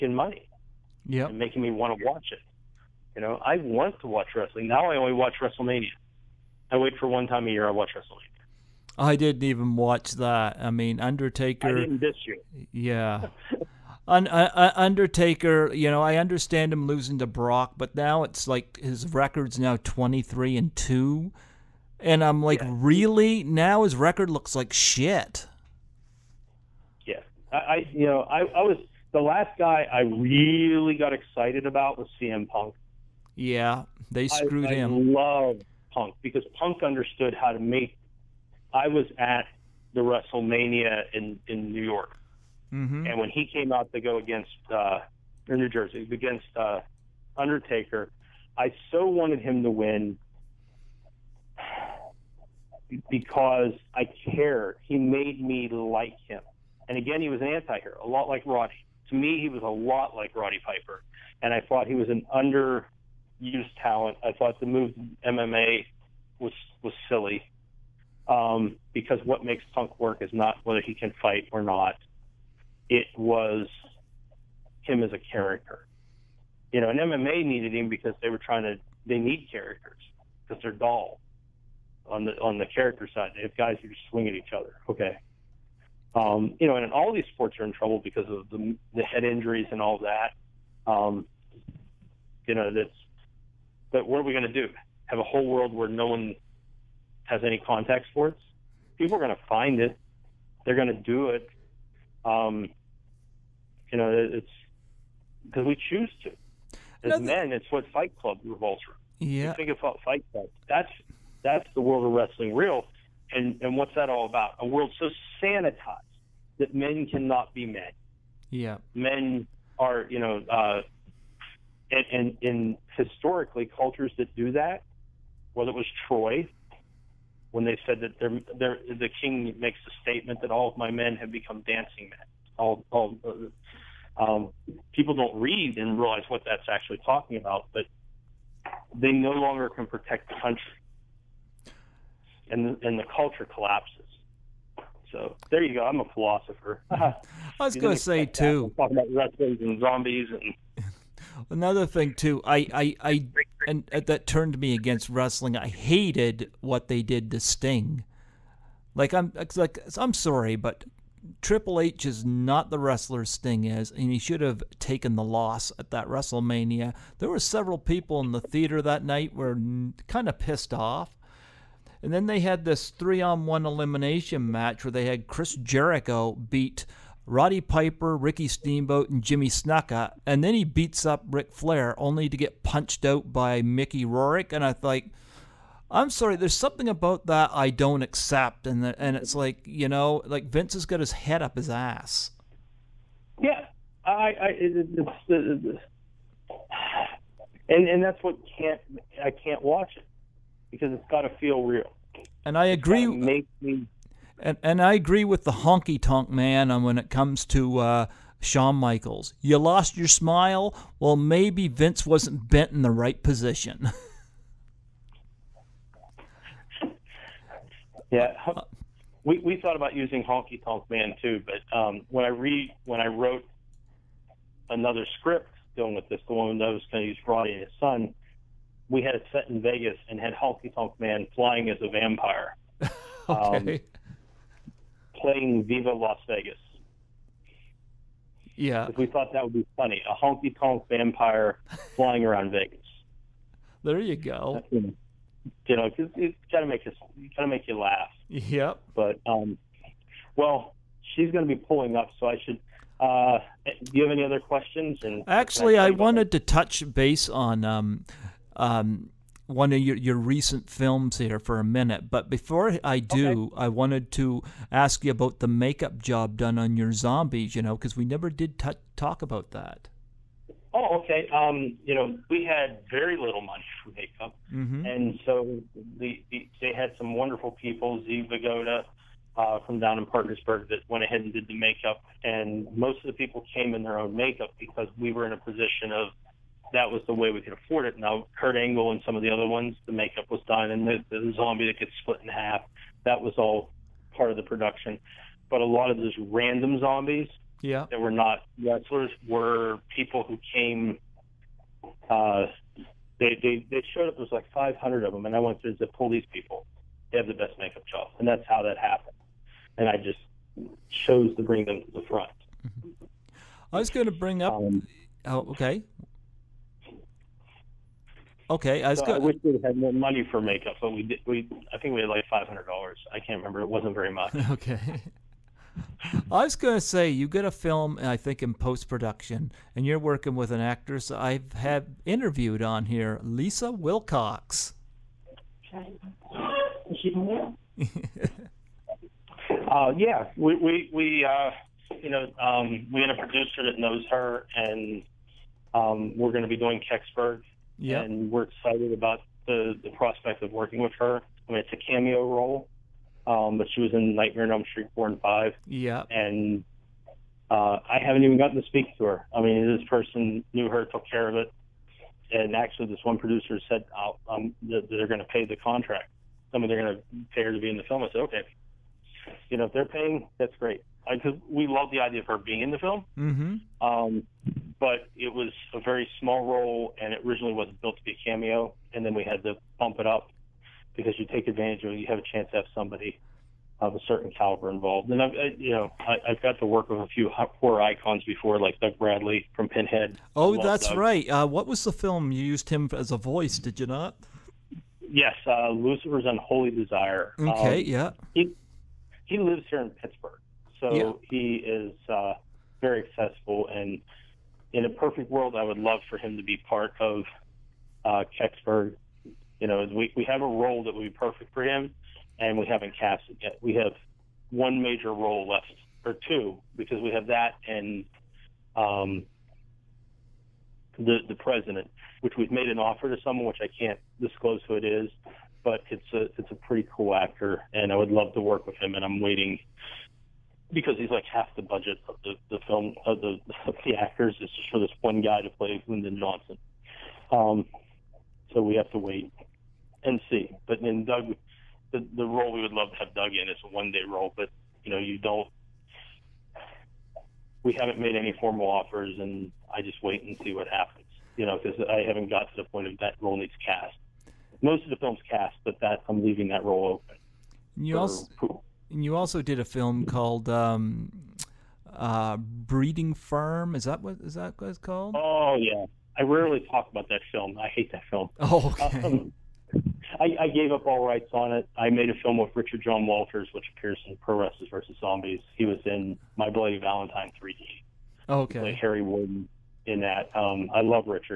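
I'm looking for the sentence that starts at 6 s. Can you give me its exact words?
I wait for one time a year I watch WrestleMania.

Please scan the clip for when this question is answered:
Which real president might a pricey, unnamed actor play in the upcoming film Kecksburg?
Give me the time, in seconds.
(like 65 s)
435 s.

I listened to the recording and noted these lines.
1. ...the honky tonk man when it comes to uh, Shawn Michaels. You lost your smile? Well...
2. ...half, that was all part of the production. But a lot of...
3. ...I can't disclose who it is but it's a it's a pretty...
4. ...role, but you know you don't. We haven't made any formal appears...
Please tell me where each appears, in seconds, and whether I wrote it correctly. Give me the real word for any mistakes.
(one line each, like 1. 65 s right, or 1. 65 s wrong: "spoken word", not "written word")
1. 205 s right
2. 292 s right
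3. 423 s right
4. 444 s wrong: "offers", not "appears".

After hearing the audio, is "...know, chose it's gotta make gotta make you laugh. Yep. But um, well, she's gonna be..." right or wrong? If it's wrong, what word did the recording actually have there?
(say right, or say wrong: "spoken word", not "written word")
wrong: "cause", not "chose".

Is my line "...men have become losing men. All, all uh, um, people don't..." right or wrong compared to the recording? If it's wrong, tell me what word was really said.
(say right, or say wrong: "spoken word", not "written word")
wrong: "dancing", not "losing".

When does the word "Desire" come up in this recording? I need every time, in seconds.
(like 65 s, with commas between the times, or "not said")
396 s.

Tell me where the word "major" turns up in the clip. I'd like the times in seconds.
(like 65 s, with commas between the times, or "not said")
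414 s.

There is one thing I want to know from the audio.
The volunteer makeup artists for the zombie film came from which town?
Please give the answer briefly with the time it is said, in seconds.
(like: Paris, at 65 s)
Parkersburg, at 280 s.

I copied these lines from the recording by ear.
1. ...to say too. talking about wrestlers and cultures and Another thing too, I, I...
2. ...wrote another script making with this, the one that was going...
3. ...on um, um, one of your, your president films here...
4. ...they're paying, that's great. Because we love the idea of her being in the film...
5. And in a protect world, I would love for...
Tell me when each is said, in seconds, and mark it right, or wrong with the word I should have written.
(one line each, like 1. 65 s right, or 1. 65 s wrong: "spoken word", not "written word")
1. 147 s wrong: "zombies", not "cultures"
2. 223 s wrong: "dealing", not "making"
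3. 257 s wrong: "recent", not "president"
4. 369 s right
5. 403 s wrong: "perfect", not "protect".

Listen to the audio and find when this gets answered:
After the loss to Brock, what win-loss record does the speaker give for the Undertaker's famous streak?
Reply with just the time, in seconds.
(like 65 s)
19 s.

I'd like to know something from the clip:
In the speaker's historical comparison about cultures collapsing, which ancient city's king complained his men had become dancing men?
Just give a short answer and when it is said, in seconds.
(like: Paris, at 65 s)
Troy, at 126 s.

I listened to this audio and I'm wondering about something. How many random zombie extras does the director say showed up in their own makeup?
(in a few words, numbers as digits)
500.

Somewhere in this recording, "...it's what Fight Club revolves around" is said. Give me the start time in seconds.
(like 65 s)
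107 s.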